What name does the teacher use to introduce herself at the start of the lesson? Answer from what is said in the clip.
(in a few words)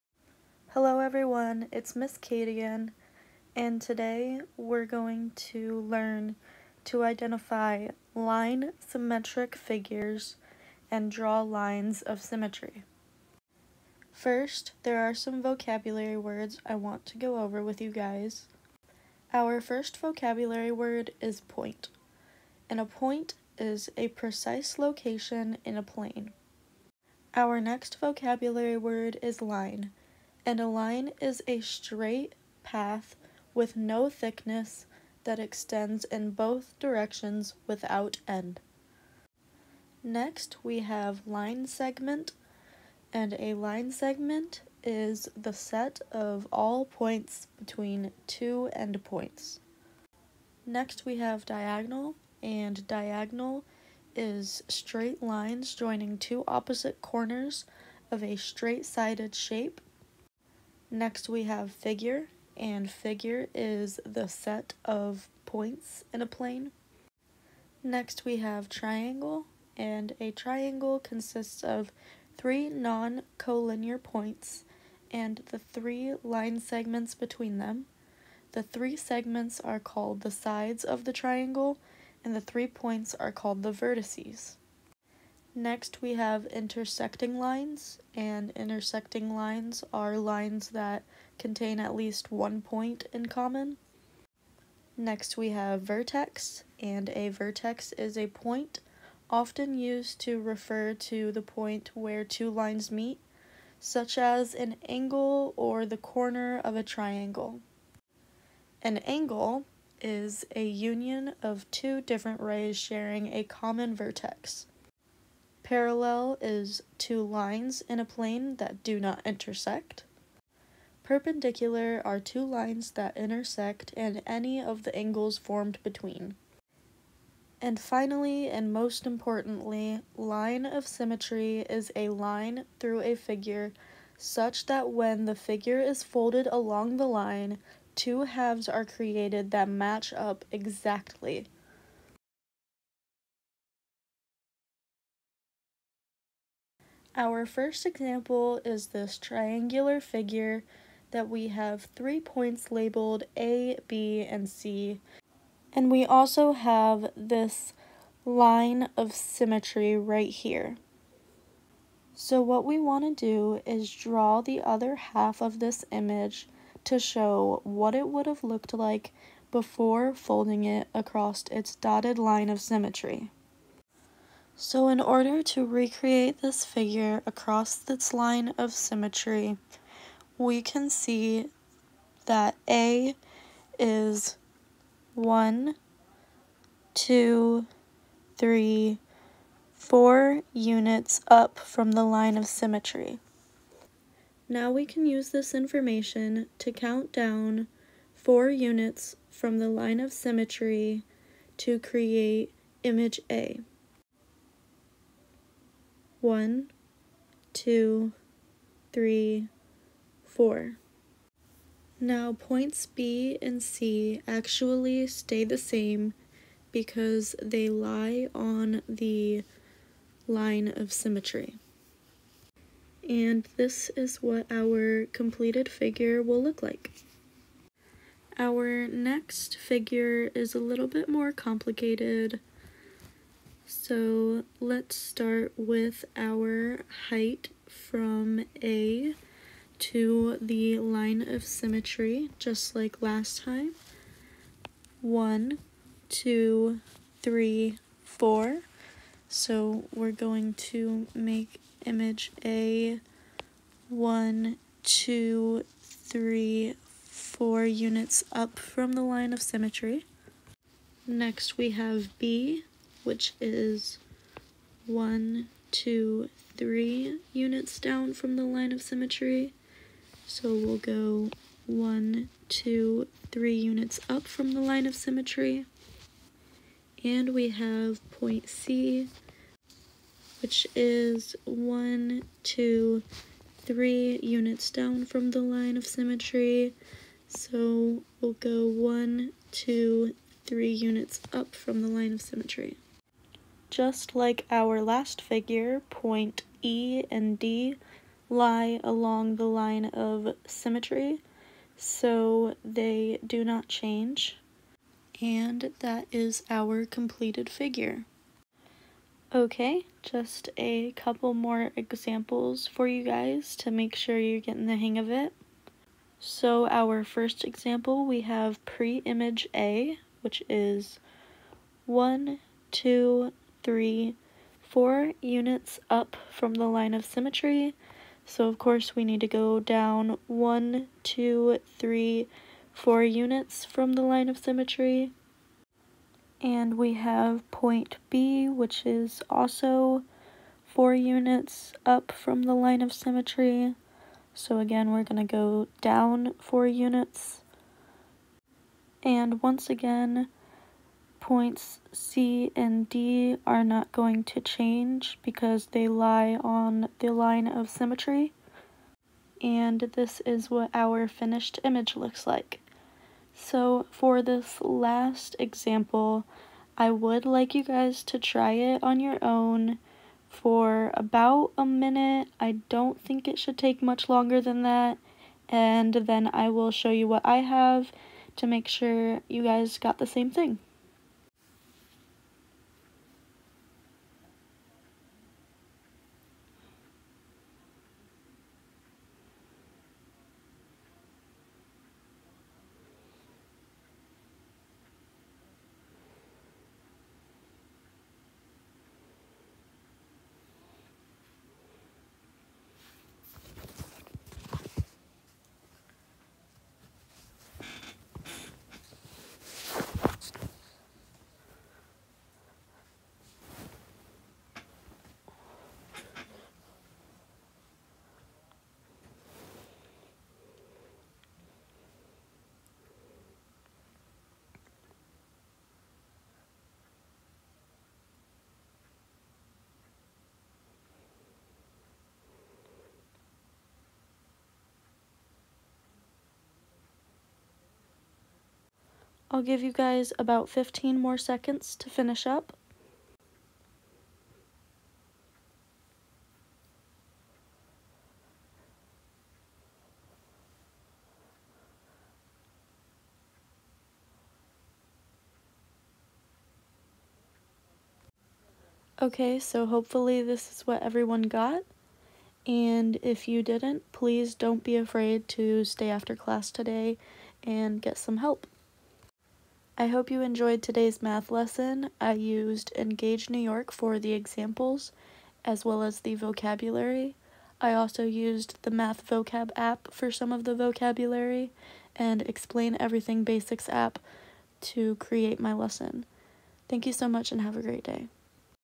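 Miss Kate.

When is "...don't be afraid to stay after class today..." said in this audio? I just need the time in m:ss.
7:44.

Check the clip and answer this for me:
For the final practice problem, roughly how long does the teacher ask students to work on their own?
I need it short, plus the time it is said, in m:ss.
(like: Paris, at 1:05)
about a minute, at 6:10.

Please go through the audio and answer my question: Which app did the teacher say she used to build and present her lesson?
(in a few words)
Explain Everything Basics.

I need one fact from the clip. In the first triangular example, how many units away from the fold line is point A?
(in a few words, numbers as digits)
4.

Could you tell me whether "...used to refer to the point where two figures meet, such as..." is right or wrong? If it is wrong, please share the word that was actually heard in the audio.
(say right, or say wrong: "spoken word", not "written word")
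wrong: "lines", not "figures".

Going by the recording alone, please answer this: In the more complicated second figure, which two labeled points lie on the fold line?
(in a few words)
E and D.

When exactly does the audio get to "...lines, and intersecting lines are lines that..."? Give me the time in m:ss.
1:27.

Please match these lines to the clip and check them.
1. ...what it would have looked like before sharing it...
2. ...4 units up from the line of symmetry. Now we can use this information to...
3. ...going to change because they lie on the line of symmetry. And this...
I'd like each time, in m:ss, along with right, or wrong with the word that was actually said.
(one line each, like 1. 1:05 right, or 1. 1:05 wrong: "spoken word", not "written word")
1. 2:47 wrong: "folding", not "sharing"
2. 3:09 right
3. 5:53 right.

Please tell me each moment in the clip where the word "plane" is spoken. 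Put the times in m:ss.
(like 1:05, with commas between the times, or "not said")
0:25, 1:06, 1:58.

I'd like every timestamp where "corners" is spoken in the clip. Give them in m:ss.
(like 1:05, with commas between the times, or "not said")
0:57, 1:45.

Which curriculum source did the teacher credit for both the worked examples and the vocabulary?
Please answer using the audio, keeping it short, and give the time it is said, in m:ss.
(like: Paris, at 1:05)
Engage New York, at 7:52.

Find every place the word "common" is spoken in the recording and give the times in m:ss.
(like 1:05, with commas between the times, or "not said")
1:33, 1:53.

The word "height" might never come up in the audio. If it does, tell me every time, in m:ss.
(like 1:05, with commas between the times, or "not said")
3:57.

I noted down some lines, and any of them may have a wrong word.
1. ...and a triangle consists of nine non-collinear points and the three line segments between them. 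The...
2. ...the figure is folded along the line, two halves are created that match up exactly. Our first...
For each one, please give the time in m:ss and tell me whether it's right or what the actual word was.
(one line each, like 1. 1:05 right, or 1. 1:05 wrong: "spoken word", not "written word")
1. 1:09 wrong: "three", not "nine"
2. 2:15 right.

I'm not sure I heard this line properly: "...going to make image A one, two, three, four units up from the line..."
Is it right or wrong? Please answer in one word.
right.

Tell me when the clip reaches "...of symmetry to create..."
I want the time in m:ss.
3:19.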